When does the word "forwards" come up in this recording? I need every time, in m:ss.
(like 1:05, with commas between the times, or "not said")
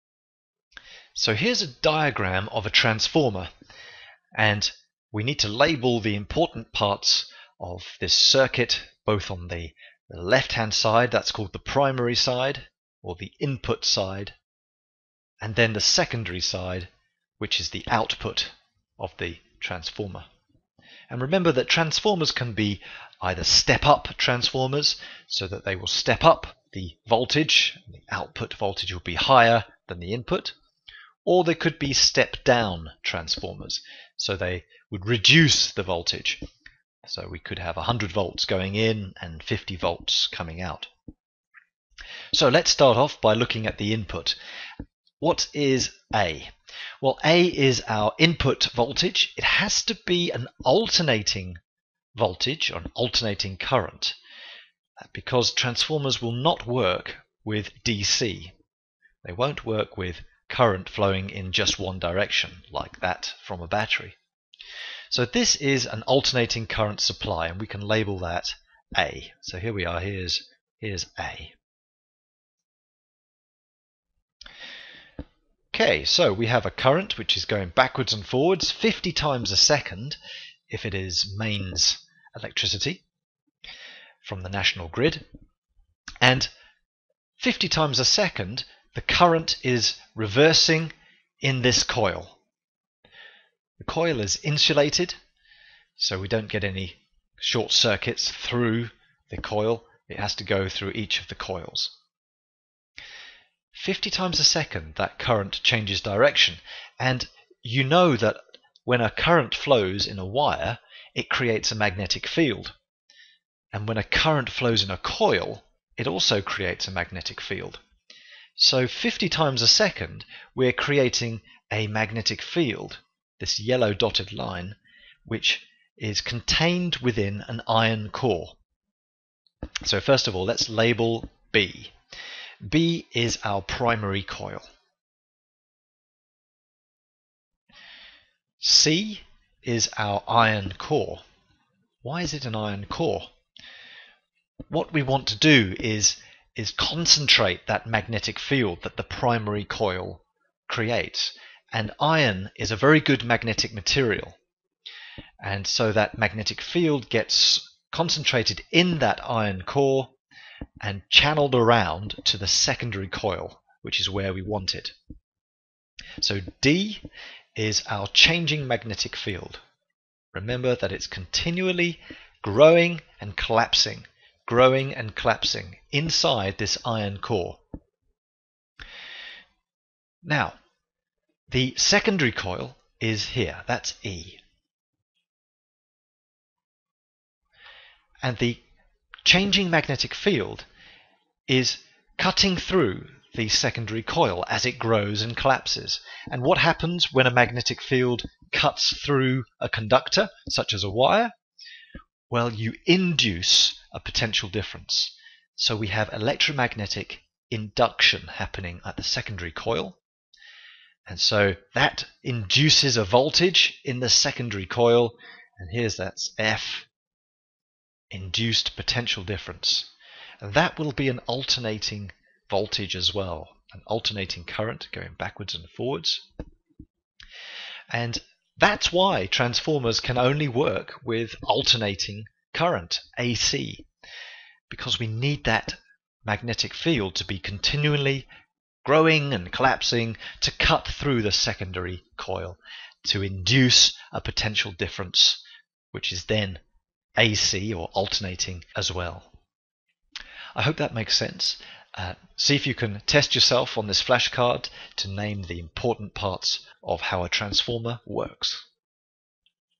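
1:18, 3:45.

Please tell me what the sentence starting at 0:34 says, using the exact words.
So they would reduce the voltage.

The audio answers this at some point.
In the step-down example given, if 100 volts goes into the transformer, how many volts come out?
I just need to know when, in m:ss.
0:39.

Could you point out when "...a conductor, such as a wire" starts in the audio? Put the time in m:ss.
3:19.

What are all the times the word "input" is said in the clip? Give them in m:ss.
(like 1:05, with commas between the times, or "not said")
0:13, 0:30, 0:43, 0:48.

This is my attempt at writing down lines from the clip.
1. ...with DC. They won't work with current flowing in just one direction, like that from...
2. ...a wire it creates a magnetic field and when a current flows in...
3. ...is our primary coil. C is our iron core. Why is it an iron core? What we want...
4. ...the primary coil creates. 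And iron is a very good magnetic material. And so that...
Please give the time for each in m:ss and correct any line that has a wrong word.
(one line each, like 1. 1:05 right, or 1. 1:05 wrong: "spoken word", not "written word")
1. 0:57 right
2. 1:50 right
3. 2:13 right
4. 2:28 right.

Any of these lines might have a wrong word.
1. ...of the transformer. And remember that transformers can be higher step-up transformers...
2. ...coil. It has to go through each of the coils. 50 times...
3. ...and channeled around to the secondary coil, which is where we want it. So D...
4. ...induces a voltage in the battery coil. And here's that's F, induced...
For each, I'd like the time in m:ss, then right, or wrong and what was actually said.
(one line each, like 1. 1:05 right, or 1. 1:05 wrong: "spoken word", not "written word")
1. 0:18 wrong: "either", not "higher"
2. 1:39 right
3. 2:40 right
4. 3:32 wrong: "secondary", not "battery".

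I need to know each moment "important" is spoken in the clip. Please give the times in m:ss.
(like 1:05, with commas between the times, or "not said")
0:06, 4:15.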